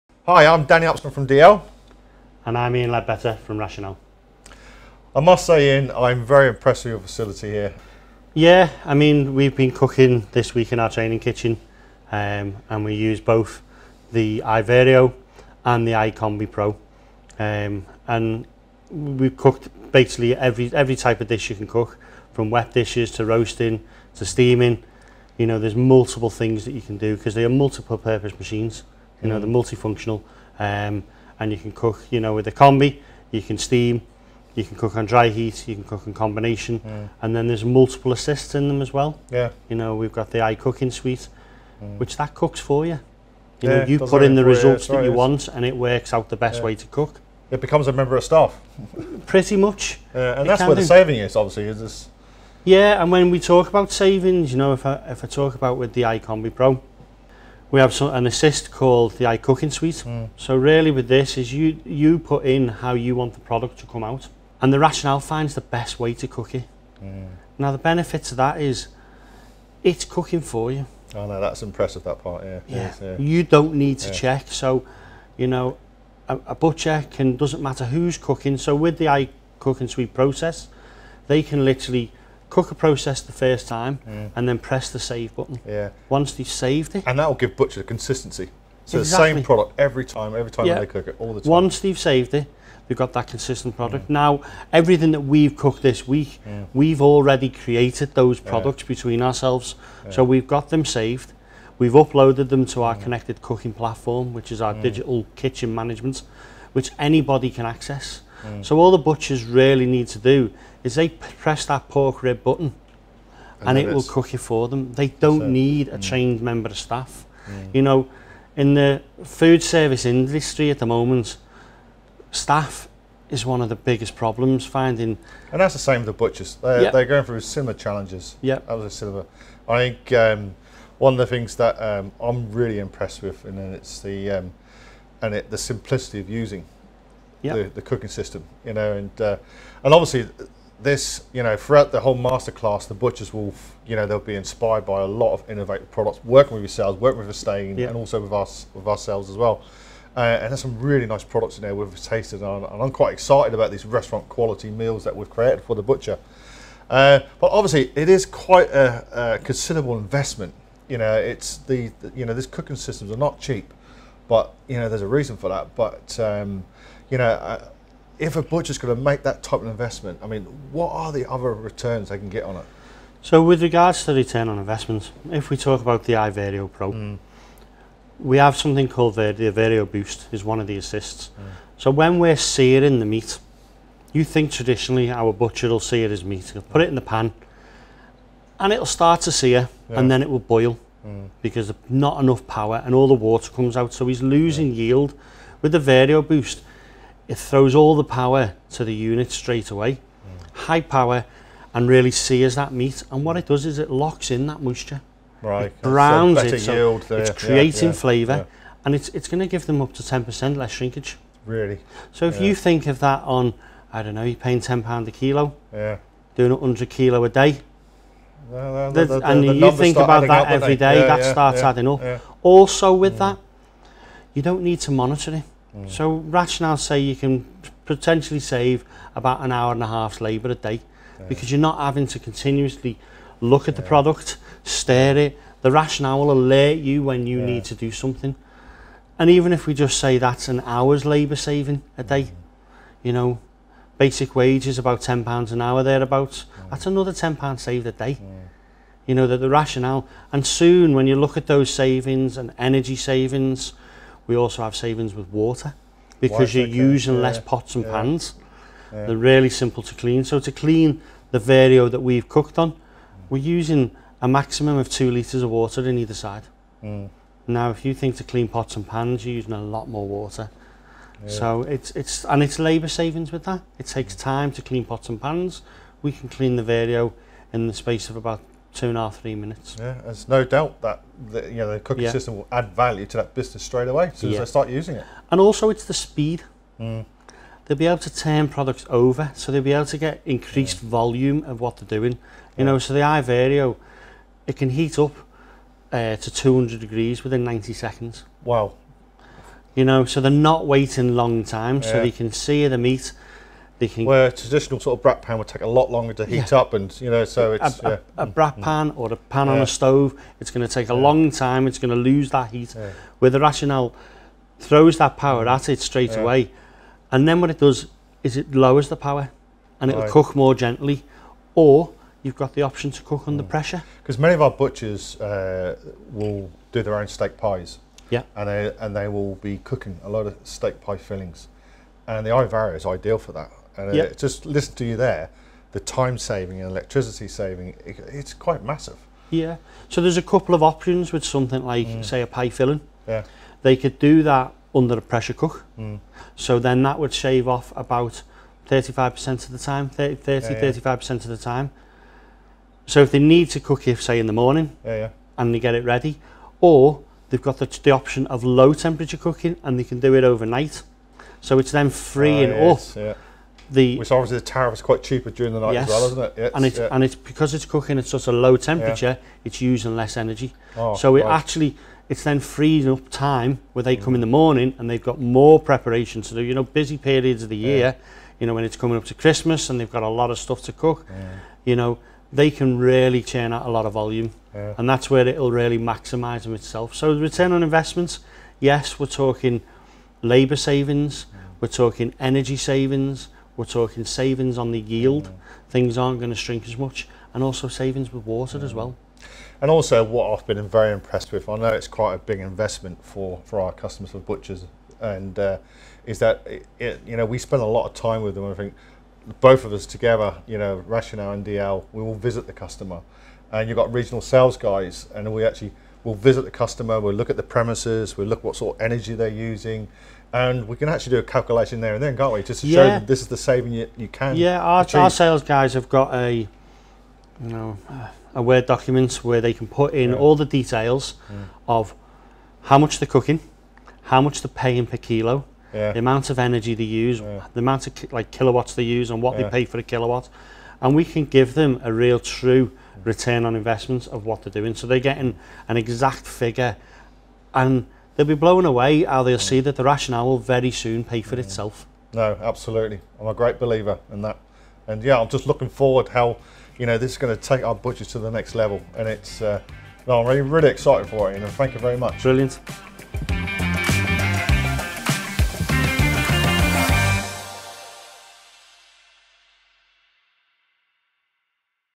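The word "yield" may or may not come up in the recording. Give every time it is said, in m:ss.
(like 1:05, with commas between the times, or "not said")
3:14, 6:34.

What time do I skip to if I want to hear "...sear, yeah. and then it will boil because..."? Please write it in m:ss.
3:09.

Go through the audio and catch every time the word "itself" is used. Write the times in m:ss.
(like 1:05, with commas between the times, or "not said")
6:26, 7:31.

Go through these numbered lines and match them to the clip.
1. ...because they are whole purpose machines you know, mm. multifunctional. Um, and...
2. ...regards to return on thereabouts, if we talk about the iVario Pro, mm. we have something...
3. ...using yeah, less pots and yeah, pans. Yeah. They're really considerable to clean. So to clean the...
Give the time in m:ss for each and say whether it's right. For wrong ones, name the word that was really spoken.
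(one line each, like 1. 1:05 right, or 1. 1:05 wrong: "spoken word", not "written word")
1. 0:27 wrong: "multiple", not "whole"
2. 2:53 wrong: "investments", not "thereabouts"
3. 4:16 wrong: "simple", not "considerable".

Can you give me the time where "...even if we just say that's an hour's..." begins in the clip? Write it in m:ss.
3:59.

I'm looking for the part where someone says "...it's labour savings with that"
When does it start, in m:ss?
4:32.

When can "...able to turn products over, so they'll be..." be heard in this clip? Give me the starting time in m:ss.
4:47.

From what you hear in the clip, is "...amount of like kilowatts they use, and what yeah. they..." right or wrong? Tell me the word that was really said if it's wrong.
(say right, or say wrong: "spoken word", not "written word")
right.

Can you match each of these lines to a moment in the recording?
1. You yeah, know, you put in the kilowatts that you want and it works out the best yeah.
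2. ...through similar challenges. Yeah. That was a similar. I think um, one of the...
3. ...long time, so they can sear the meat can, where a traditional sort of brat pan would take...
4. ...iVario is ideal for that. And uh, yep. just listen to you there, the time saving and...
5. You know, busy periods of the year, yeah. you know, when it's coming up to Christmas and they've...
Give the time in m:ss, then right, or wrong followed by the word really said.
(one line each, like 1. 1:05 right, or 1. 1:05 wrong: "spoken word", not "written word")
1. 0:43 wrong: "results", not "kilowatts"
2. 2:07 right
3. 5:01 right
4. 5:32 right
5. 6:16 right.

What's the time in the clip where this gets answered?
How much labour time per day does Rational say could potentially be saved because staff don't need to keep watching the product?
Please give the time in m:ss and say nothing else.
3:49.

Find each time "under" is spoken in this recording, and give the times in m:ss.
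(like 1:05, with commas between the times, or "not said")
5:23, 5:44.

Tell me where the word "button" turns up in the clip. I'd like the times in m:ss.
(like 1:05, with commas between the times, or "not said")
1:25, 1:52.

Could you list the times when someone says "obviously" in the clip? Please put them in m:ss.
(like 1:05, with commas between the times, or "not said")
0:51, 2:19, 2:37, 6:04.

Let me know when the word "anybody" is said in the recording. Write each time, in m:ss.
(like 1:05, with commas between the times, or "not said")
1:46.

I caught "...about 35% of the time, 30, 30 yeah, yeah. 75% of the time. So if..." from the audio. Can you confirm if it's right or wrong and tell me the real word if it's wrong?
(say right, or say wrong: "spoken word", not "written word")
wrong: "35", not "75".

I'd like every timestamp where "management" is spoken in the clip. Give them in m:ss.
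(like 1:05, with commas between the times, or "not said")
1:45.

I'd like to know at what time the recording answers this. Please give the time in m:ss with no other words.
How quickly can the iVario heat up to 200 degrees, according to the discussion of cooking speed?
4:57.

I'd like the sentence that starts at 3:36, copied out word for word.
doing 100 kilo a day, the, the, and the you think about that every day, yeah, that yeah, starts yeah, adding up.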